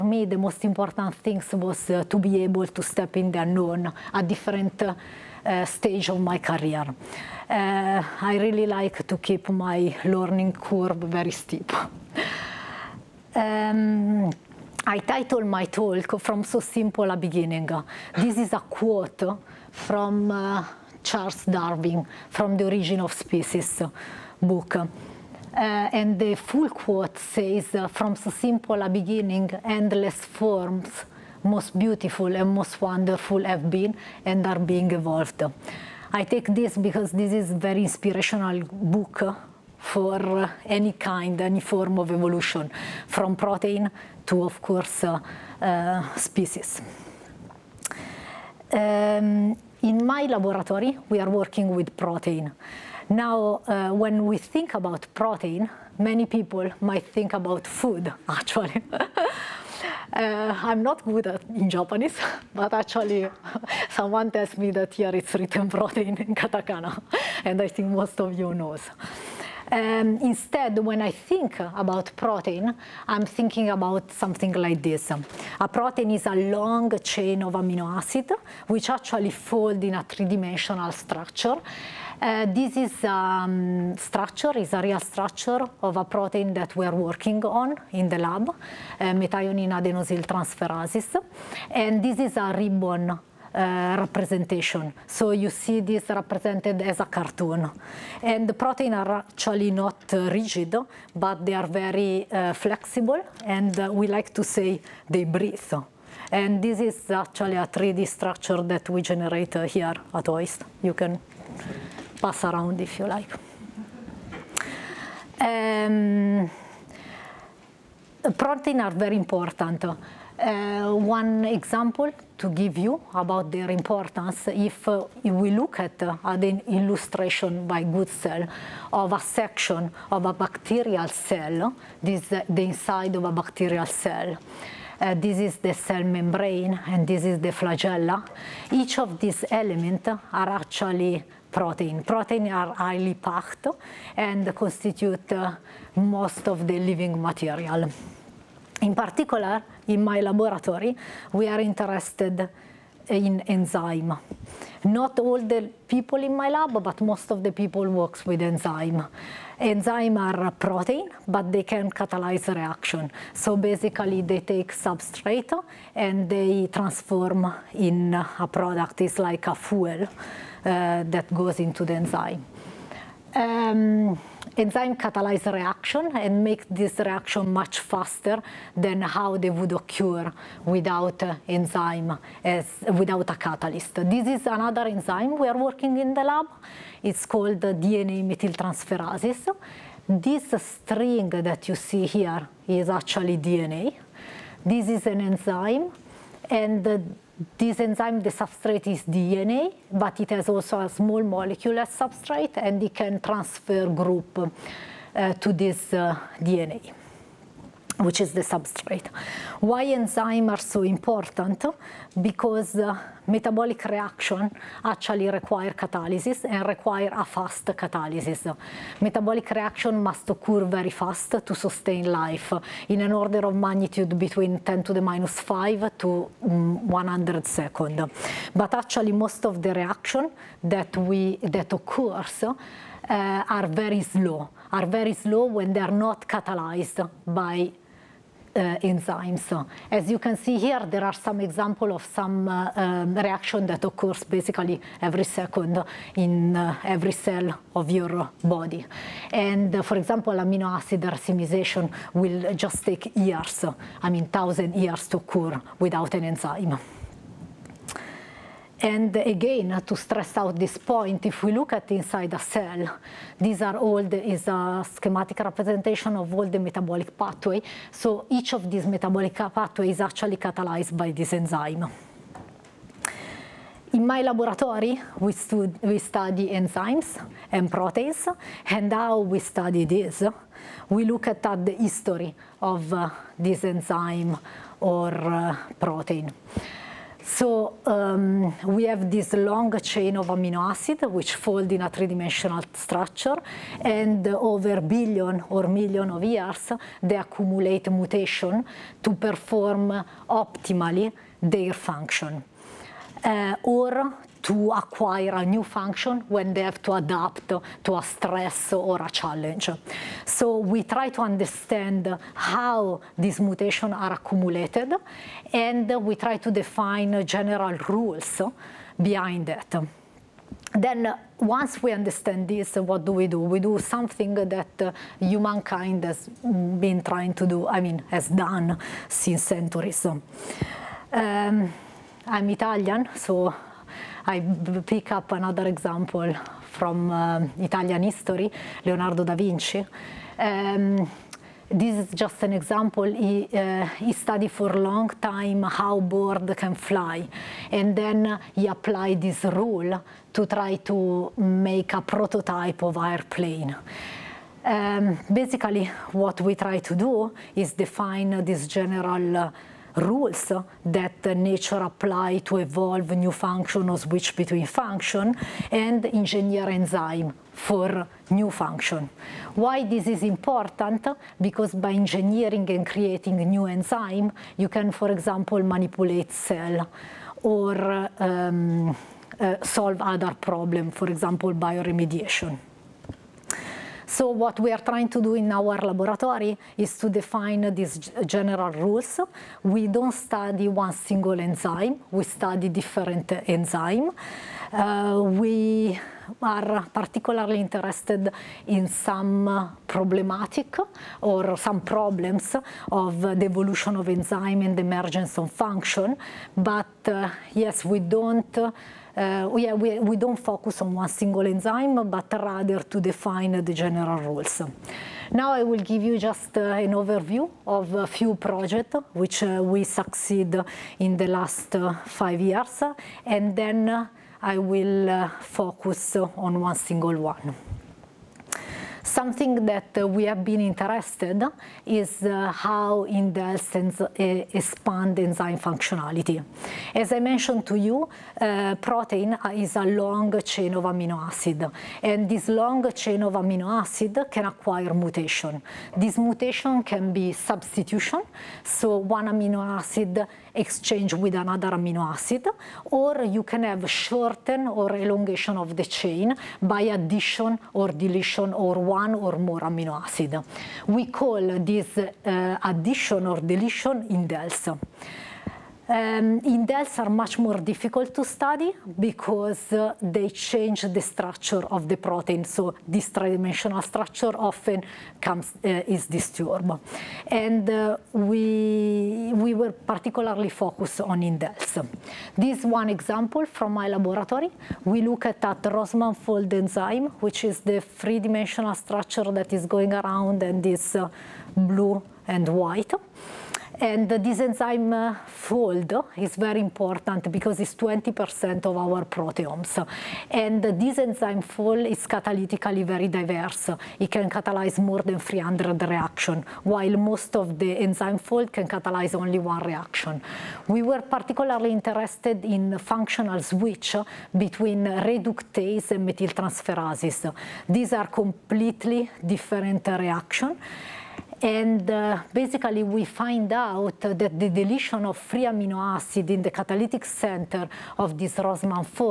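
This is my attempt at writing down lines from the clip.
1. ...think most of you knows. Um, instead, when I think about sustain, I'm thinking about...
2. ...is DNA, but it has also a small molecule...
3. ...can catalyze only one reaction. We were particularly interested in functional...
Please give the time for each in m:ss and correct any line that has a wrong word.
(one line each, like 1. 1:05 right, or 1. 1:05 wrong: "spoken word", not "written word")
1. 1:07 wrong: "protein", not "sustain"
2. 3:18 right
3. 8:28 right.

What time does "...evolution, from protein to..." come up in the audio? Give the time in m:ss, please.
0:42.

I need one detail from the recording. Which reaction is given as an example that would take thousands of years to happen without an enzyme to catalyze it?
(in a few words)
amino acid racemization.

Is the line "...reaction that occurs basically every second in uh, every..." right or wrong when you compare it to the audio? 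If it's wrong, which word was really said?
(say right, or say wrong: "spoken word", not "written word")
right.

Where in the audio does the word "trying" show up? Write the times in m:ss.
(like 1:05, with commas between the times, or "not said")
5:27, 6:24.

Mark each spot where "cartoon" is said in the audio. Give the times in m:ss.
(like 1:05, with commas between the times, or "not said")
1:37.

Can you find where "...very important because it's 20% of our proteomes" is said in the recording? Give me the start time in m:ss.
8:16.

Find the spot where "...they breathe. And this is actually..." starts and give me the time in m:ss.
1:45.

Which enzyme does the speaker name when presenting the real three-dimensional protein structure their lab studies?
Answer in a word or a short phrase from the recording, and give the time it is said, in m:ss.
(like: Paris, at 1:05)
methionine adenosyl transferases, at 1:29.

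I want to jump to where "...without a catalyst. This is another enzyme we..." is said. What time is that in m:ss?
3:02.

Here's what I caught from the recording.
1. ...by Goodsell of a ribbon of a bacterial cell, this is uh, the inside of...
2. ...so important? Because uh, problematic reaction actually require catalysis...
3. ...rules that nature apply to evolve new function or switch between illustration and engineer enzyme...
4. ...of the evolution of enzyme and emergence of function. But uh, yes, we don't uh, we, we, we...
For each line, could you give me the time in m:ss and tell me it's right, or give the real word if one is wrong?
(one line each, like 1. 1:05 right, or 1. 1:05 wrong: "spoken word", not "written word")
1. 2:07 wrong: "section", not "ribbon"
2. 3:30 wrong: "metabolic", not "problematic"
3. 5:59 wrong: "function", not "illustration"
4. 6:42 right.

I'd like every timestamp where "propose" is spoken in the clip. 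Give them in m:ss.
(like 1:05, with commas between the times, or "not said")
not said.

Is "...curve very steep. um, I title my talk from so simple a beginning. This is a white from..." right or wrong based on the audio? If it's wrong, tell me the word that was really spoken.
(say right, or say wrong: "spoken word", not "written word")
wrong: "quote", not "white".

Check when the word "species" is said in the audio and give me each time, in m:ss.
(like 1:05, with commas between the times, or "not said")
0:23, 0:46.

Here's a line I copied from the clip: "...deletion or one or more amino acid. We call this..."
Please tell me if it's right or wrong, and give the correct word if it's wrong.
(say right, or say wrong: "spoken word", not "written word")
right.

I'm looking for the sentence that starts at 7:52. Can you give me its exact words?
So this dimensional structure often comes uh, is disturbed, and uh, we we were particularly focused on indels.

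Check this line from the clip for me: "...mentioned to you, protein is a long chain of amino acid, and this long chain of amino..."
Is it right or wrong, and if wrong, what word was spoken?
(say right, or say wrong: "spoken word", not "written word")
right.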